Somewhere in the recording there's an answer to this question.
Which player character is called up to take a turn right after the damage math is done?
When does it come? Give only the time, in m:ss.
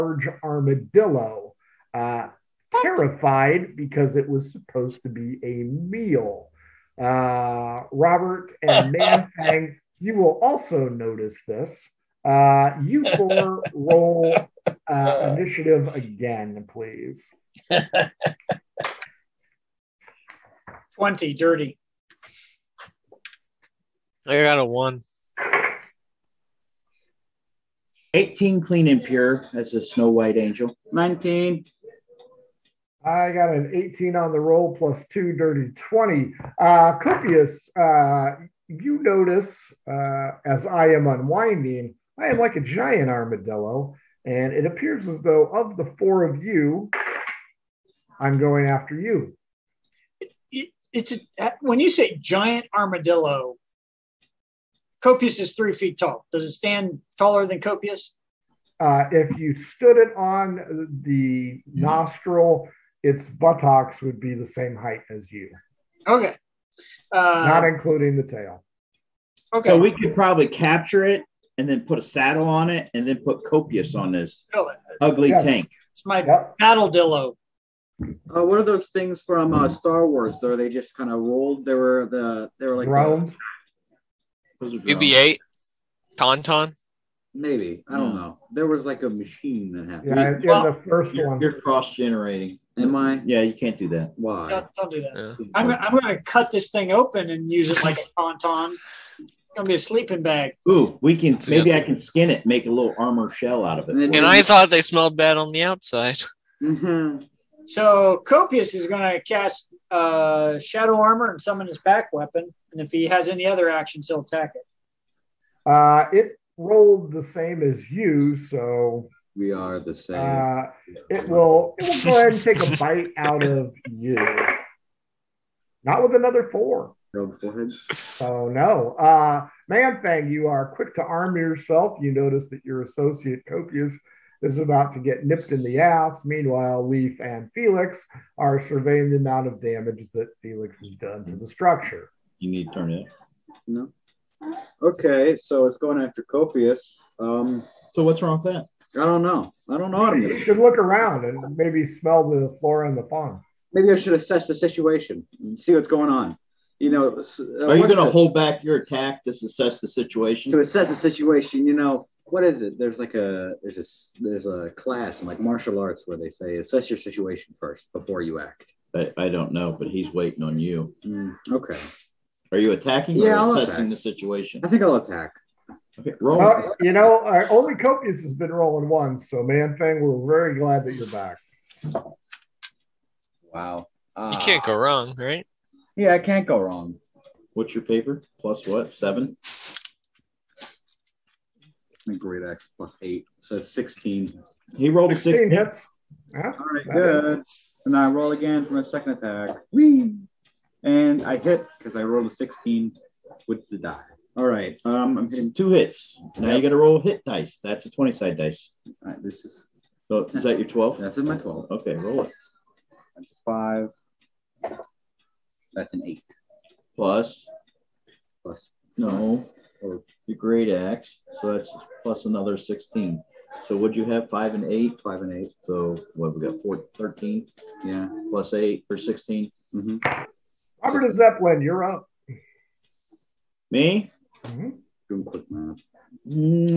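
3:50.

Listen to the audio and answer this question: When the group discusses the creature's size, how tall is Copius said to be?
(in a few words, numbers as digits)
3 feet.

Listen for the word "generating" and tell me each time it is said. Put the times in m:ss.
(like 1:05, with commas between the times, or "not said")
1:31.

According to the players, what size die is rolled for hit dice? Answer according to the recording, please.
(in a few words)
20-sided.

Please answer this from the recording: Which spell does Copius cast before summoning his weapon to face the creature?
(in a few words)
Shadow armor.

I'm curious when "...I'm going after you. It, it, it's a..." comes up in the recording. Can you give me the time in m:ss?
0:48.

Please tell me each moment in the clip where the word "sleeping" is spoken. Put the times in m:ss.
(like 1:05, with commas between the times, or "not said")
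1:39.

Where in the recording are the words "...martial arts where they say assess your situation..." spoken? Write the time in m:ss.
2:45.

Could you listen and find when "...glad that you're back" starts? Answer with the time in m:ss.
3:00.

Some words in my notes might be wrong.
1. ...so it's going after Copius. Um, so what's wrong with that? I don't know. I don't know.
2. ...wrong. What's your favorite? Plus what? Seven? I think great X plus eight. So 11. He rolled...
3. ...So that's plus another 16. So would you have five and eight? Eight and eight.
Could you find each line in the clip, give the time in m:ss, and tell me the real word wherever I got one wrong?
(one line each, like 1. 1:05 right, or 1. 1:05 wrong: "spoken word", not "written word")
1. 2:25 right
2. 3:06 wrong: "16", not "11"
3. 3:41 wrong: "Five", not "Eight".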